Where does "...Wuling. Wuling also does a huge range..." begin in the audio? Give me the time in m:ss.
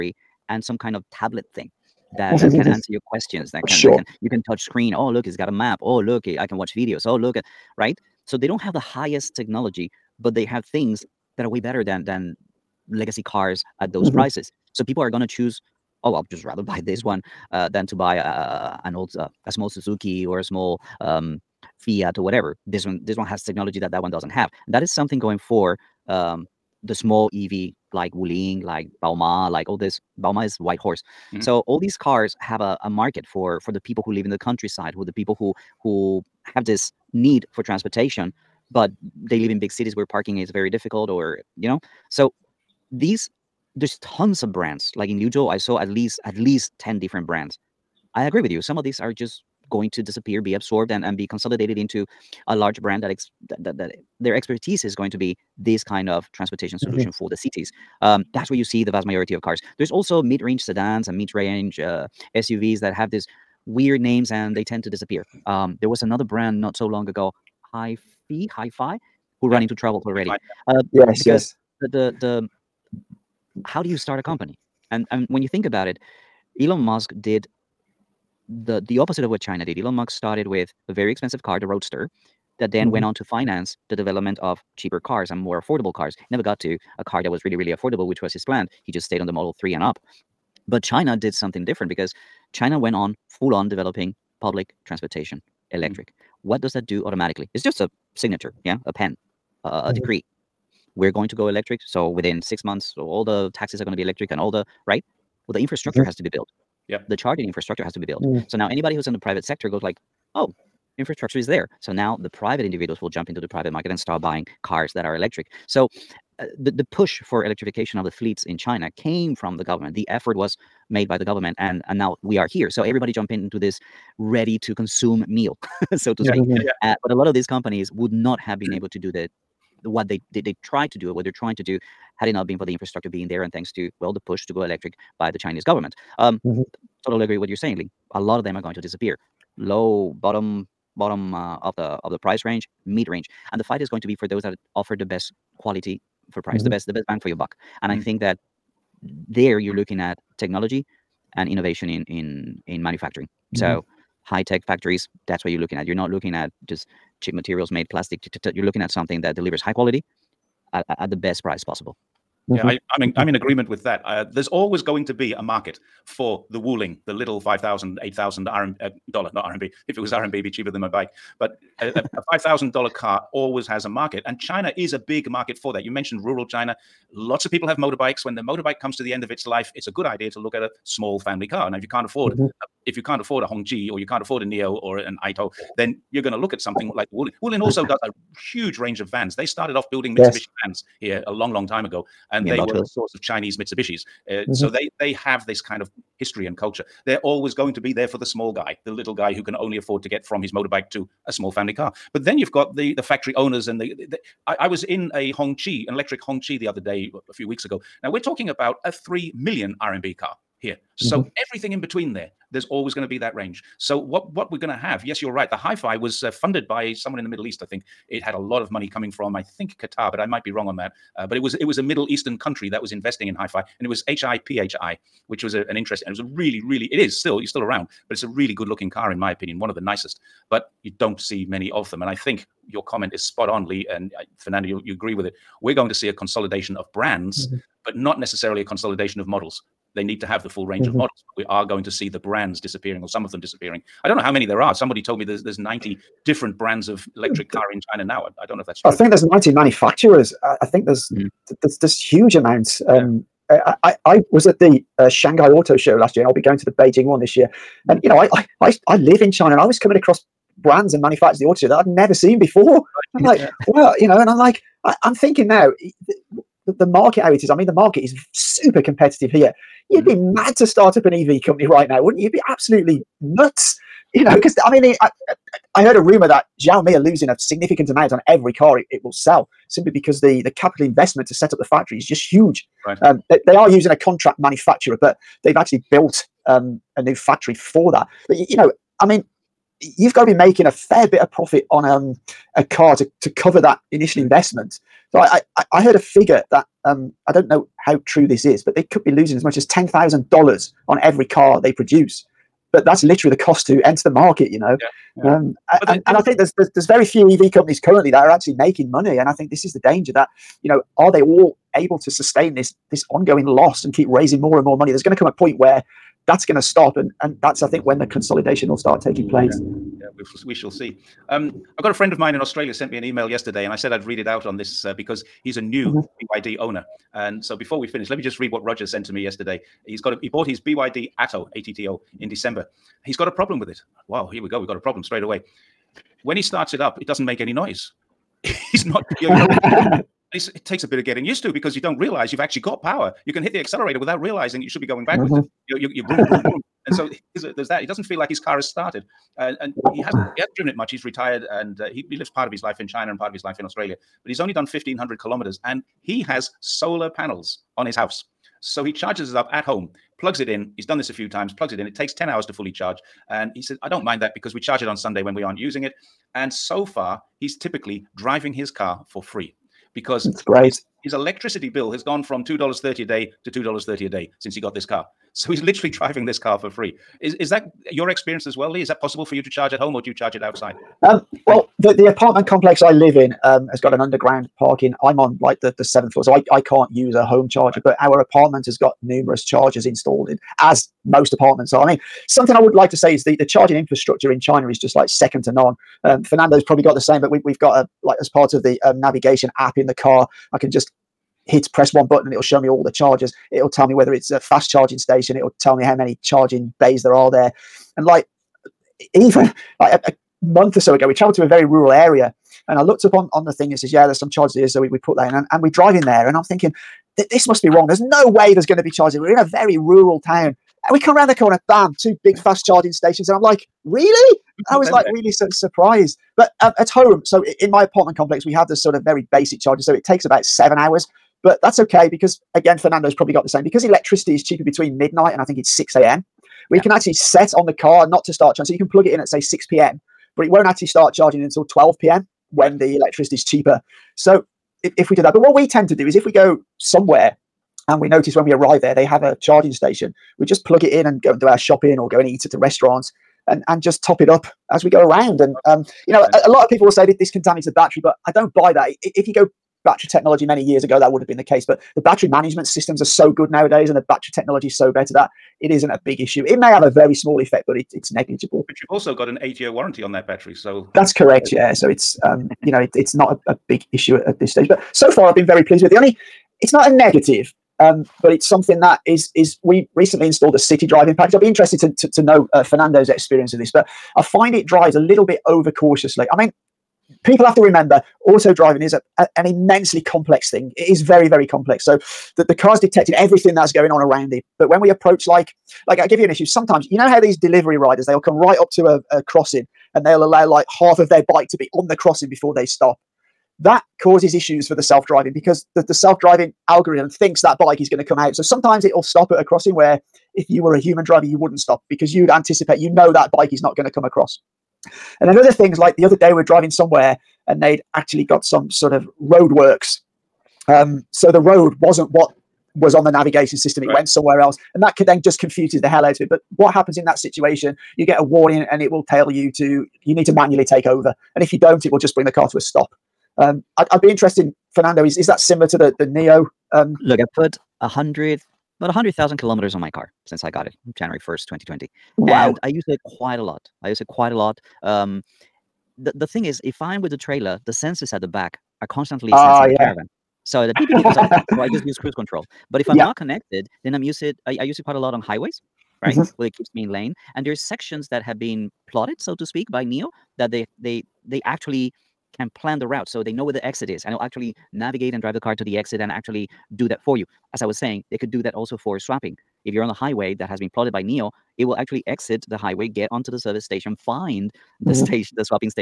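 3:07.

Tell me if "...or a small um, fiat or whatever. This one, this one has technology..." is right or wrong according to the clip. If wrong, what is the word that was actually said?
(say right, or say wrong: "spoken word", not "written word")
right.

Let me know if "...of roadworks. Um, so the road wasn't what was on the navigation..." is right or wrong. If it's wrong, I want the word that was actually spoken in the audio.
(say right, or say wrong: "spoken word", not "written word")
right.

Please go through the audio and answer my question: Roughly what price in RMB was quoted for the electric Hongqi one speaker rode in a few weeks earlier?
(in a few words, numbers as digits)
3 million RMB.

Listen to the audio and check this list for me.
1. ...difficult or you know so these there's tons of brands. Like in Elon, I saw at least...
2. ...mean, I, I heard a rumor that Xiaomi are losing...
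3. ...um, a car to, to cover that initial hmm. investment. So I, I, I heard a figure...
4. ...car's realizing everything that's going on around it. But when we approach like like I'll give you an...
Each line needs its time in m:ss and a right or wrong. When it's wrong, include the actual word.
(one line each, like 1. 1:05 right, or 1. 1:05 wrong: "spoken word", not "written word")
1. 0:40 wrong: "Liuzhou", not "Elon"
2. 4:34 right
3. 4:51 right
4. 8:12 wrong: "detecting", not "realizing".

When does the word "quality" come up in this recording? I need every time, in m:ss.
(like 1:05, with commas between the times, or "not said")
2:25, 2:39.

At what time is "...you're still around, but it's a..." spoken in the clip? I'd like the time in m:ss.
3:47.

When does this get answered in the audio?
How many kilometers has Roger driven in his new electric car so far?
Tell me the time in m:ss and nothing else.
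5:54.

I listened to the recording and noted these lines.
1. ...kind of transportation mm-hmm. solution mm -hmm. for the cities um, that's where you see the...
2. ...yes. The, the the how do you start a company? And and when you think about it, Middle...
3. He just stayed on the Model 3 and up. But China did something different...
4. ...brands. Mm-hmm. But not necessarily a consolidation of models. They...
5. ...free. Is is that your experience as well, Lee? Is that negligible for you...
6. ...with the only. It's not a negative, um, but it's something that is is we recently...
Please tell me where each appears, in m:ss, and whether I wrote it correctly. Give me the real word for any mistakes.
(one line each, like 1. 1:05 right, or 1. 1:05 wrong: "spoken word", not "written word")
1. 0:55 right
2. 1:11 wrong: "Elon", not "Middle"
3. 1:28 right
4. 3:56 right
5. 6:16 wrong: "possible", not "negligible"
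6. 7:55 right.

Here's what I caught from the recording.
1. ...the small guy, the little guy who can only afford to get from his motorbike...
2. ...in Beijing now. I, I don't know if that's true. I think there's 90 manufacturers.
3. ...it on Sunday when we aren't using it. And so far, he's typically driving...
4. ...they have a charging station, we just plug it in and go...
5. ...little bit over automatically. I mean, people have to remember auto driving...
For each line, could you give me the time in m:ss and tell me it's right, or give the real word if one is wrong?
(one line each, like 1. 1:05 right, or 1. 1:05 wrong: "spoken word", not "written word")
1. 3:18 right
2. 4:07 wrong: "China", not "Beijing"
3. 6:04 right
4. 7:28 right
5. 8:04 wrong: "cautiously", not "automatically".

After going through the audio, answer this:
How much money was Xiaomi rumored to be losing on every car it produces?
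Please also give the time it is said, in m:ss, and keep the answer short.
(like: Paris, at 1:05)
$10,000, at 4:59.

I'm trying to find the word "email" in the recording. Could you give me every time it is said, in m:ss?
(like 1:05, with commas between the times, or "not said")
5:23.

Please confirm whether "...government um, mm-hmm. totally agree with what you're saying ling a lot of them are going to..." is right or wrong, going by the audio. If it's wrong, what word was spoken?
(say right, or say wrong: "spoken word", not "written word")
right.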